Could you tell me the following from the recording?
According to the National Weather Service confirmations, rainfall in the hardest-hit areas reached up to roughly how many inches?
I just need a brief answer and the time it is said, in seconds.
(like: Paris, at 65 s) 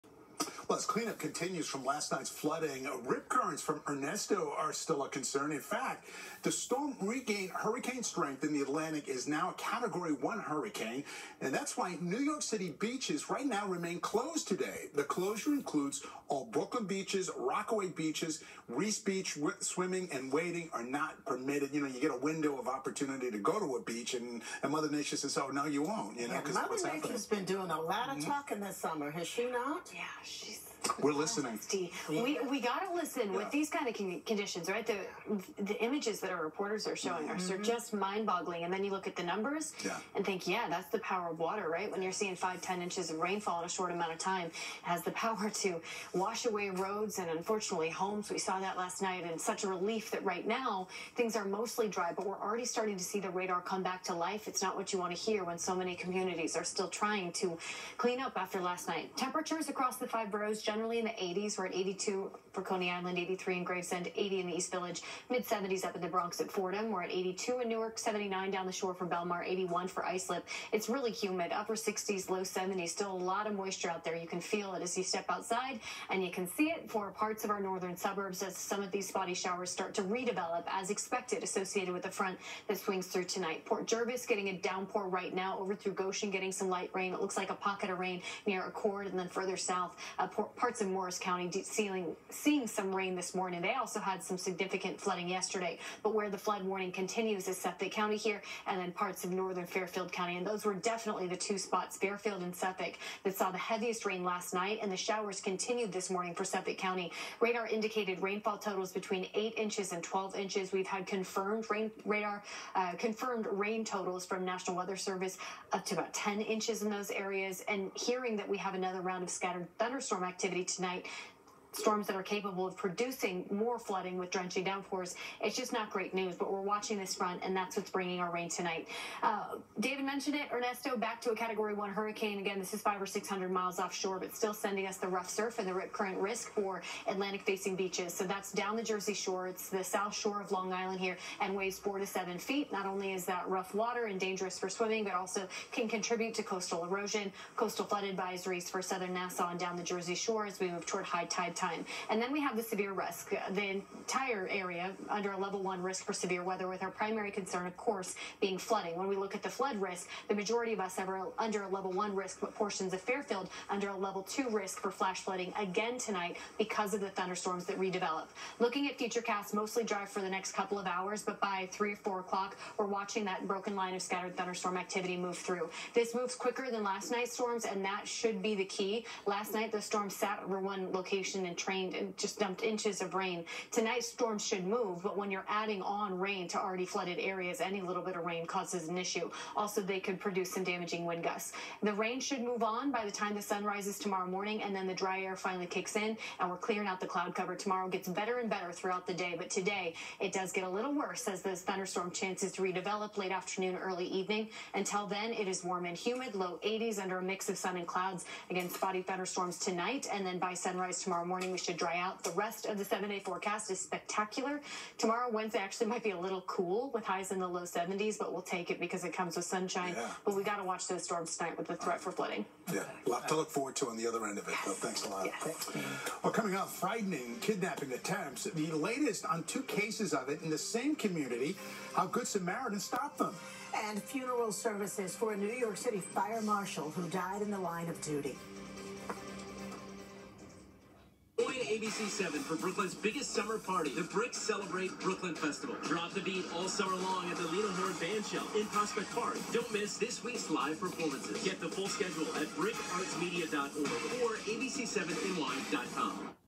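10 inches, at 115 s.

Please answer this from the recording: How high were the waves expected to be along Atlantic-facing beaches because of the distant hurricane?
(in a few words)
4 to 7 feet.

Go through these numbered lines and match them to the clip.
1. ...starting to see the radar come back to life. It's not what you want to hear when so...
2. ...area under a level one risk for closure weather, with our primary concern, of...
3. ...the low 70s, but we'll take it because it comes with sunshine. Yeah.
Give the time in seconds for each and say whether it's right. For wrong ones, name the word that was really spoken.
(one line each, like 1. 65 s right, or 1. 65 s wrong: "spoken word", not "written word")
1. 52 s right
2. 154 s wrong: "severe", not "closure"
3. 217 s right.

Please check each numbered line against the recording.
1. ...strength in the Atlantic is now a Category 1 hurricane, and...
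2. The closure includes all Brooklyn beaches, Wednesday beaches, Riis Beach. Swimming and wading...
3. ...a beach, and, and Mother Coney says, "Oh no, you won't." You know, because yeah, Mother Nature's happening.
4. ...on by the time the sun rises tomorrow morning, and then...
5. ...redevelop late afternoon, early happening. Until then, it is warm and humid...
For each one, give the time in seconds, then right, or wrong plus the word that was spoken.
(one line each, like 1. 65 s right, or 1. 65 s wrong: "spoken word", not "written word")
1. 8 s right
2. 14 s wrong: "Rockaway", not "Wednesday"
3. 23 s wrong: "Nature", not "Coney"
4. 192 s right
5. 202 s wrong: "evening", not "happening".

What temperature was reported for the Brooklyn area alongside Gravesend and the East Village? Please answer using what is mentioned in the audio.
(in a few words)
82.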